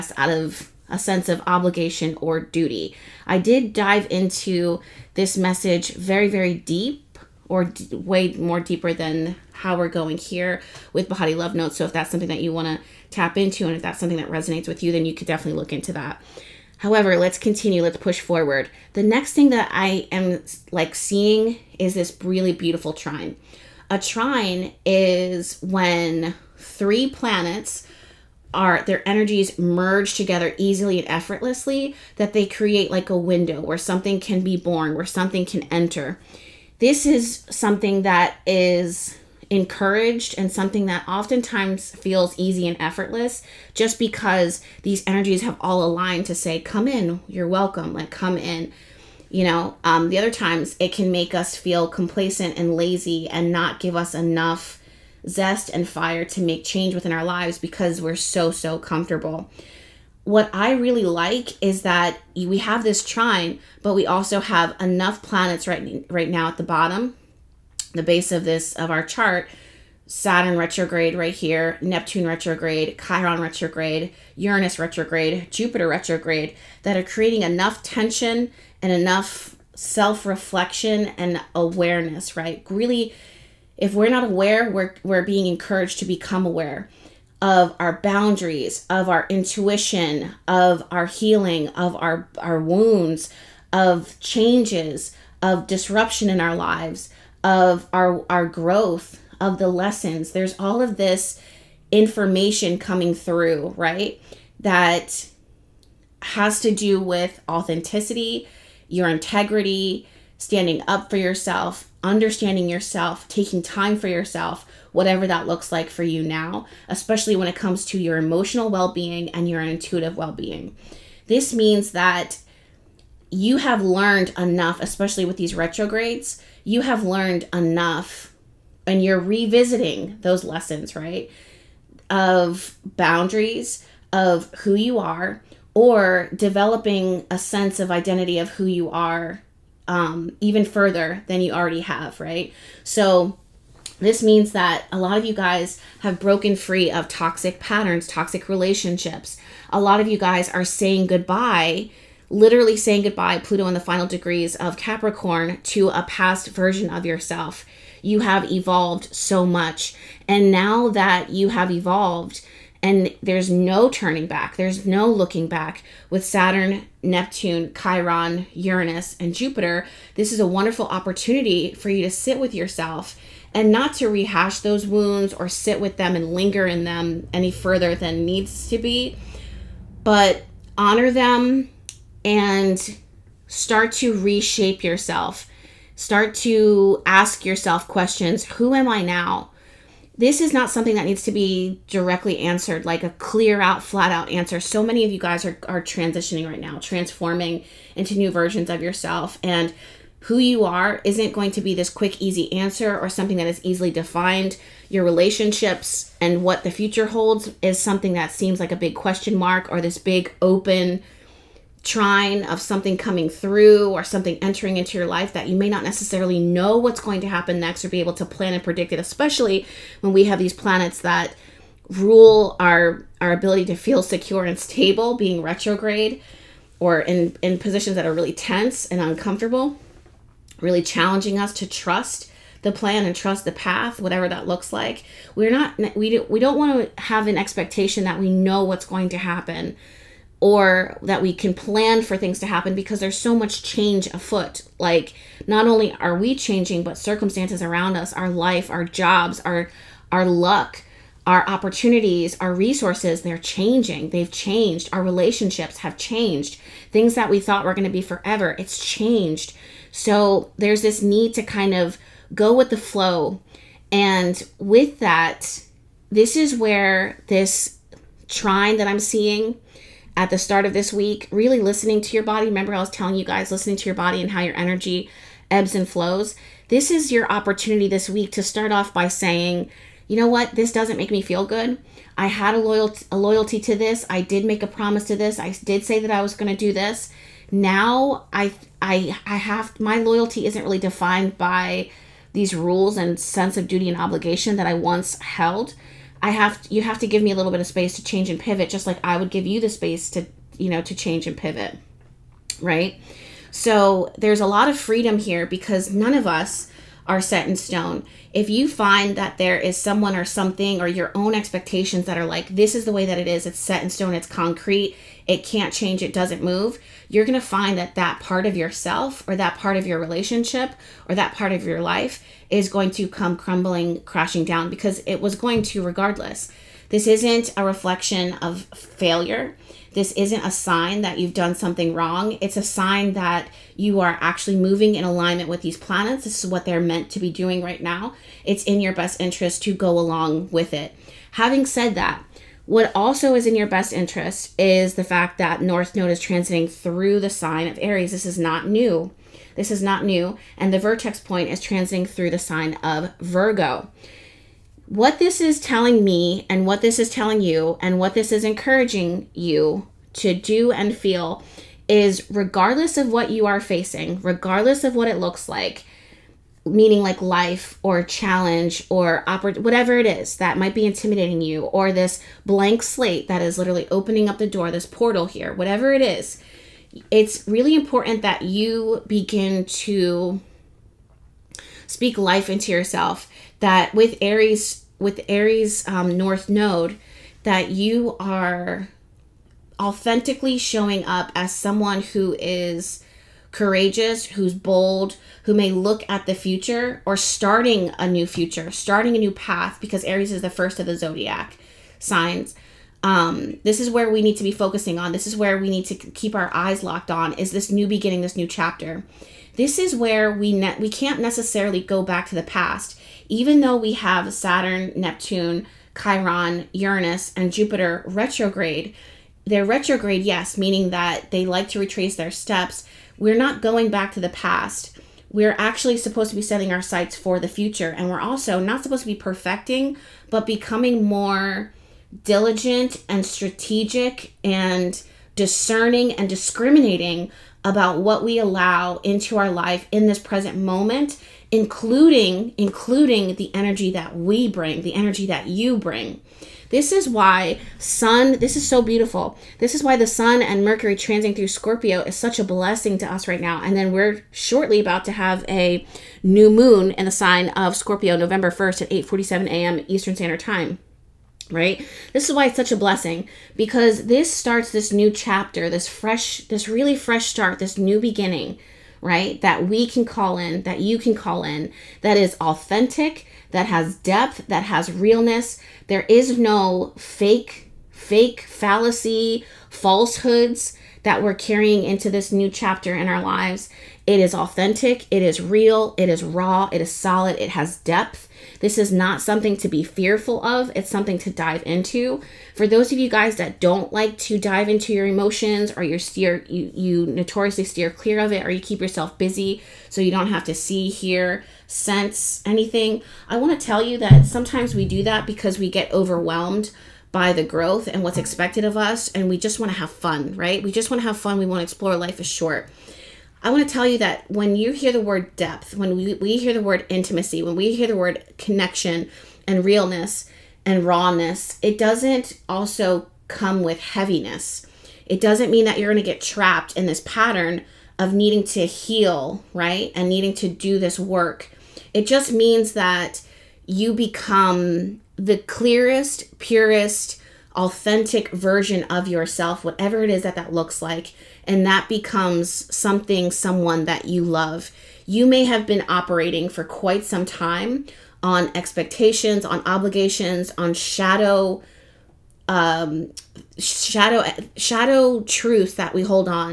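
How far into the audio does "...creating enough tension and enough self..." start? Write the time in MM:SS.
01:17.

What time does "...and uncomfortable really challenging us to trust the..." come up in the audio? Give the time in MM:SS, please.
03:48.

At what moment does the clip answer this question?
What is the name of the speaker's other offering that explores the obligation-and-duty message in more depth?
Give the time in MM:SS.
00:11.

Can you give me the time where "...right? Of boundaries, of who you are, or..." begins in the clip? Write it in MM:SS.
02:10.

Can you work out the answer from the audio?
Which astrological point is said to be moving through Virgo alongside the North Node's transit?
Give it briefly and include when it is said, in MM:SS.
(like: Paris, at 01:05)
vertex point, at 05:50.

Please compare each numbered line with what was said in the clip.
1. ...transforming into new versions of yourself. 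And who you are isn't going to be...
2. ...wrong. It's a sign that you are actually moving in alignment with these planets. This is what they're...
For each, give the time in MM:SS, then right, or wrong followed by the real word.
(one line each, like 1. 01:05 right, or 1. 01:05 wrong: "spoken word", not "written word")
1. 03:16 right
2. 05:31 right.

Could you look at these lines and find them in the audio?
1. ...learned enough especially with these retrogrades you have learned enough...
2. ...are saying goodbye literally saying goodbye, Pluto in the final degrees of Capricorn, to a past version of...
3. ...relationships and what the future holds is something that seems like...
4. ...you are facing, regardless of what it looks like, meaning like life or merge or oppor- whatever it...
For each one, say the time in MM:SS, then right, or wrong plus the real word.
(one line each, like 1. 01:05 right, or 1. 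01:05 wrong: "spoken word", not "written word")
1. 02:03 right
2. 02:30 right
3. 03:25 right
4. 06:03 wrong: "challenge", not "merge".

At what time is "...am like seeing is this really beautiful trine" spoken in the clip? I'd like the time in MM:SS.
00:20.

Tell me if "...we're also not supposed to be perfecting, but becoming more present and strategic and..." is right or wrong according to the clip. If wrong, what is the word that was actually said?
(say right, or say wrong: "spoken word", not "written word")
wrong: "diligent", not "present".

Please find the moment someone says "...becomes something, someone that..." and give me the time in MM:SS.
09:01.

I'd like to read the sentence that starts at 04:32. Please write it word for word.
Remember, I was telling you guys listening to your body and how your energy ebbs and flows.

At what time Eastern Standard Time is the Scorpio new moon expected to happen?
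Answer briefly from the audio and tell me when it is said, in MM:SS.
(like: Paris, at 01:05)
8:47 a.m., at 07:38.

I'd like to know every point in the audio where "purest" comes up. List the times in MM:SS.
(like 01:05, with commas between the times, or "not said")
08:56.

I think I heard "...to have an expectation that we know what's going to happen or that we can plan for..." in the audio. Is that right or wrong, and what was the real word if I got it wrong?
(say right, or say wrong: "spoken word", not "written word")
right.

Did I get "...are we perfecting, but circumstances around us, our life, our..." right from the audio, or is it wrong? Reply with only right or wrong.
wrong.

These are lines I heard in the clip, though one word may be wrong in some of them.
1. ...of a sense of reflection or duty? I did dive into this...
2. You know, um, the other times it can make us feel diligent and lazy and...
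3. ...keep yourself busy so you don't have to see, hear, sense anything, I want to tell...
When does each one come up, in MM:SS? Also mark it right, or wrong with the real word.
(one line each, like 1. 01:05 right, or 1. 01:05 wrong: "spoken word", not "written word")
1. 00:00 wrong: "obligation", not "reflection"
2. 00:49 wrong: "complacent", not "diligent"
3. 08:18 right.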